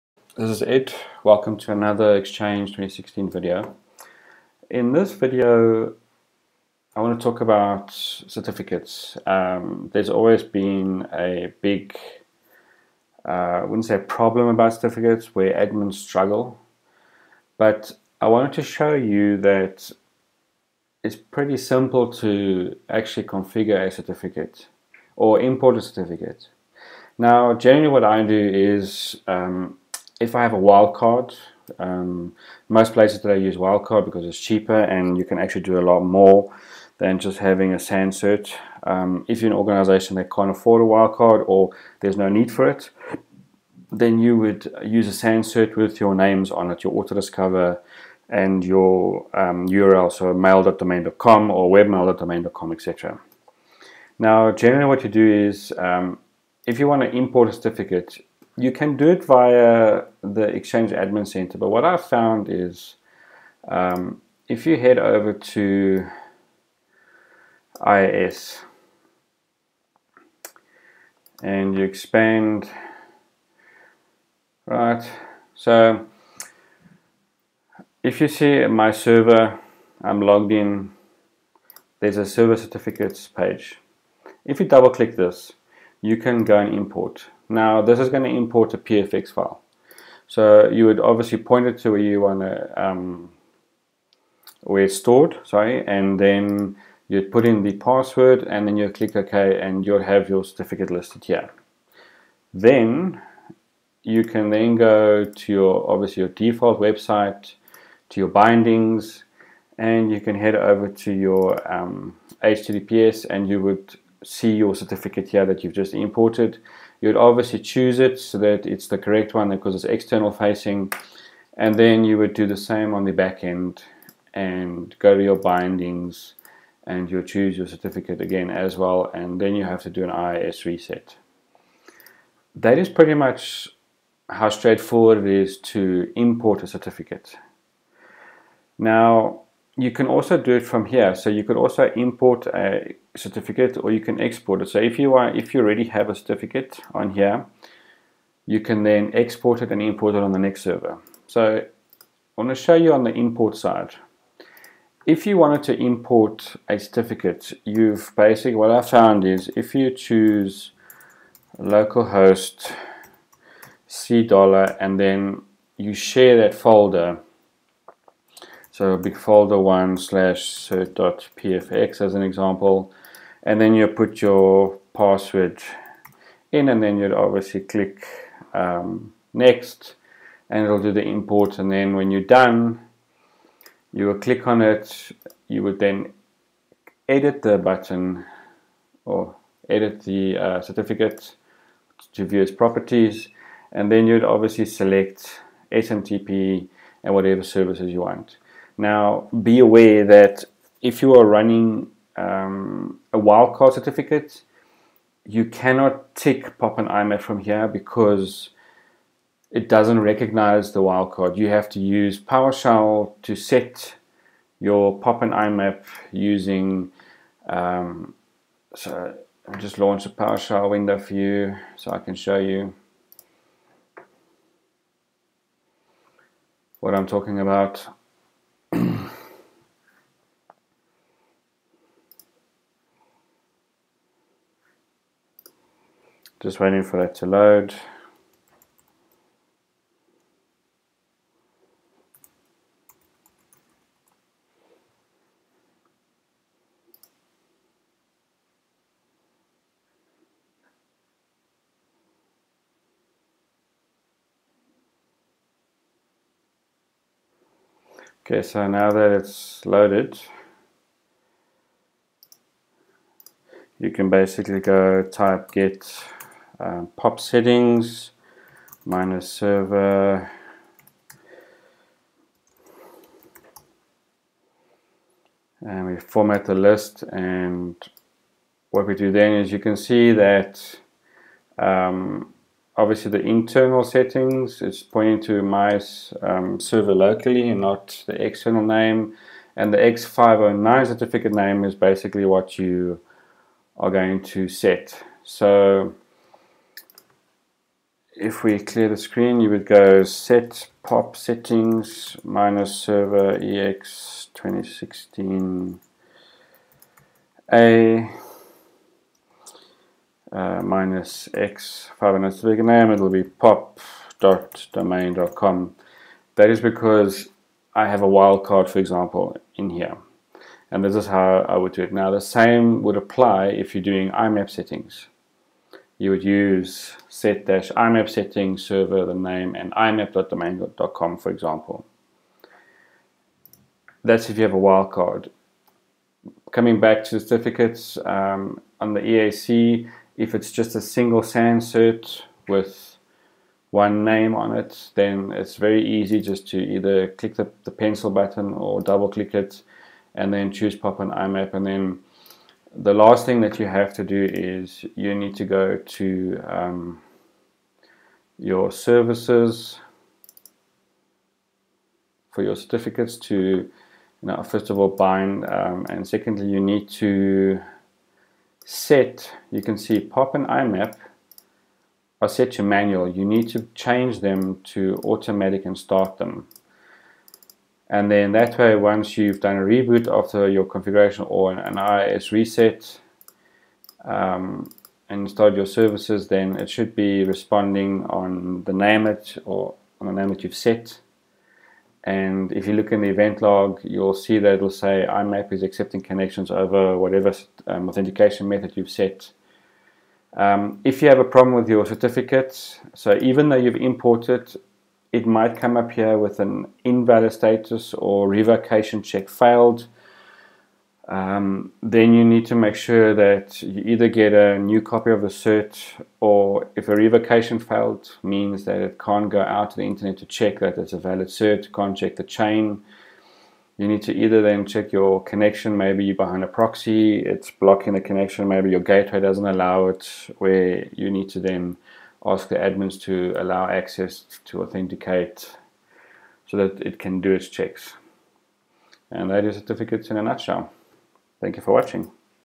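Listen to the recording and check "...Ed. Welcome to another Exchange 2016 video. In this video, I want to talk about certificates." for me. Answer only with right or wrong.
right.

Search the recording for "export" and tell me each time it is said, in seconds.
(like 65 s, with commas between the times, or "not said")
144 s, 149 s.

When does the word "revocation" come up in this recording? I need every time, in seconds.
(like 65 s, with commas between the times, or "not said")
408 s, 416 s.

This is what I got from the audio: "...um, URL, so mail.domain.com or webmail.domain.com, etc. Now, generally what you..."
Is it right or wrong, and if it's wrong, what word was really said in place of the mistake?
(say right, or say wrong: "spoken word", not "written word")
right.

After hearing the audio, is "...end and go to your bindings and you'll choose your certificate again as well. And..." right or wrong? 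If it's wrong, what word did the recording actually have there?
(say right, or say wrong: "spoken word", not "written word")
right.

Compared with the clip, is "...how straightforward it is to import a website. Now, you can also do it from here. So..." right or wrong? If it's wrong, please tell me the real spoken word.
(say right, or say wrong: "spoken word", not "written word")
wrong: "certificate", not "website".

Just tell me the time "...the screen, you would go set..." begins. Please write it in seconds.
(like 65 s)
298 s.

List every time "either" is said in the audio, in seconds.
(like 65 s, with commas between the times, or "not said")
346 s, 413 s, 424 s.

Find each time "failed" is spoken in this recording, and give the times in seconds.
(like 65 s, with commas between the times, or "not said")
409 s, 417 s.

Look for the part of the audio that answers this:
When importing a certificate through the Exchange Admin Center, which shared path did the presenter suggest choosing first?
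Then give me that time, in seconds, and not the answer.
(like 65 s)
161 s.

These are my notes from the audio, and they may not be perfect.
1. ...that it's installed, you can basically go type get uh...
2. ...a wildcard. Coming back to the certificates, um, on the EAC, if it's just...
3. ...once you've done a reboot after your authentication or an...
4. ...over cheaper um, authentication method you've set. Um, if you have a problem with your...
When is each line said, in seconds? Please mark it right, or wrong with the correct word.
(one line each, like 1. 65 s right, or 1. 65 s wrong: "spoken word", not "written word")
1. 258 s wrong: "loaded", not "installed"
2. 334 s right
3. 378 s wrong: "configuration", not "authentication"
4. 396 s wrong: "whatever", not "cheaper".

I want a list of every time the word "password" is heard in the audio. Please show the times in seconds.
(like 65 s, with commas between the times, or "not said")
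97 s, 174 s.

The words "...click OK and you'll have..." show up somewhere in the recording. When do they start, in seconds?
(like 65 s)
98 s.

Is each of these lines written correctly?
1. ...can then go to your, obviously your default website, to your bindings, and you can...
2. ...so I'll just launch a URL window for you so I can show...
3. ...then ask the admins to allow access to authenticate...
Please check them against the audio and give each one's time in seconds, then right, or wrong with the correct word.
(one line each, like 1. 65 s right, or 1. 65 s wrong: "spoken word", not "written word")
1. 104 s right
2. 218 s wrong: "PowerShell", not "URL"
3. 431 s right.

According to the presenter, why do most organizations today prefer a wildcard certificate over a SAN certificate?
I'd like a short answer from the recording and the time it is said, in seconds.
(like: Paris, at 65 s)
It's cheaper, at 34 s.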